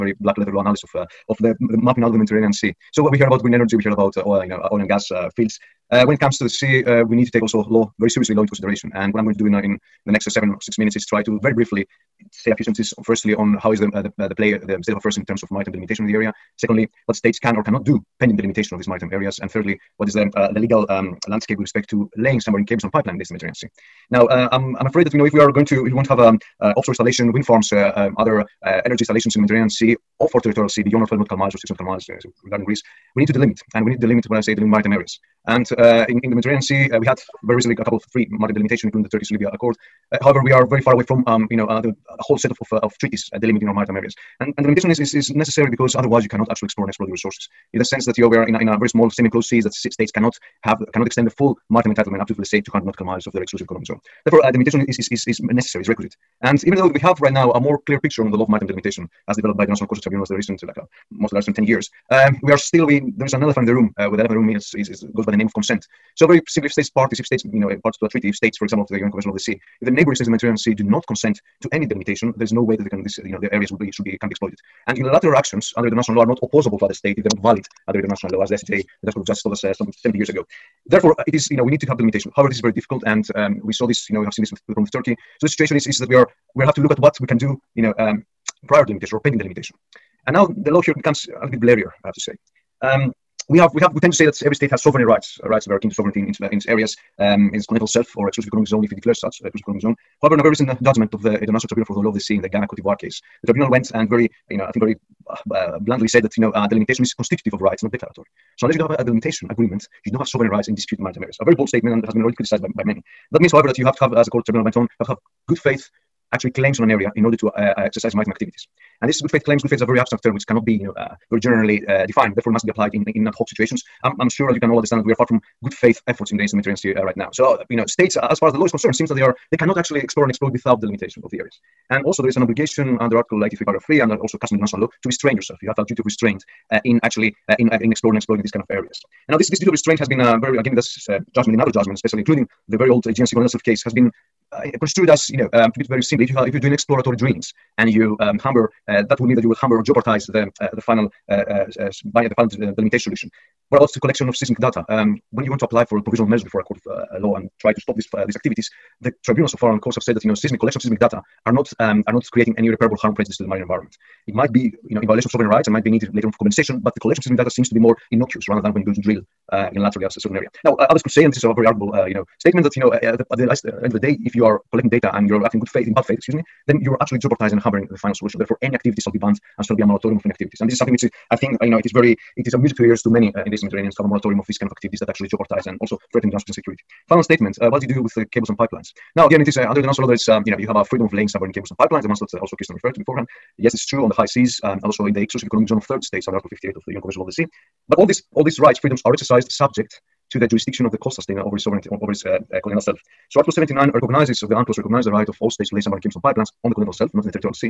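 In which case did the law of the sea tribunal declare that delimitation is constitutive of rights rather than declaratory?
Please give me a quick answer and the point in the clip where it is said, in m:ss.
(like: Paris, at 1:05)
Ghana Cote d'Ivoire, at 1:42.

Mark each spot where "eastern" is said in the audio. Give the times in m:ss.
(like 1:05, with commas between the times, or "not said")
2:06, 3:03.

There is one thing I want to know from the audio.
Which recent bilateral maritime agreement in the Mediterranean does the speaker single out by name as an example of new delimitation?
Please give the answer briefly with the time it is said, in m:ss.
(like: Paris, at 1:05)
Turkish-Libya Accord, at 0:39.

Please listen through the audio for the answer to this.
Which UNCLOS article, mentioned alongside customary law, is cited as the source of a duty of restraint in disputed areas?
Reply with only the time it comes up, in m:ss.
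2:13.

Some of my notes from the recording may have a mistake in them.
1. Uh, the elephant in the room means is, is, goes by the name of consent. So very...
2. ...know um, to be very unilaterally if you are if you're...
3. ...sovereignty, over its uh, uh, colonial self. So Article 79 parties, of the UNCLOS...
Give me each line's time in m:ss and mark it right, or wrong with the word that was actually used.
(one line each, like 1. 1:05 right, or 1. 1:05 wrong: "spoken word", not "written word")
1. 1:03 right
2. 2:25 wrong: "simply", not "unilaterally"
3. 3:21 wrong: "recognizes", not "parties".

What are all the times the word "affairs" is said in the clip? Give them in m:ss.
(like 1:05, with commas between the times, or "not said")
0:14.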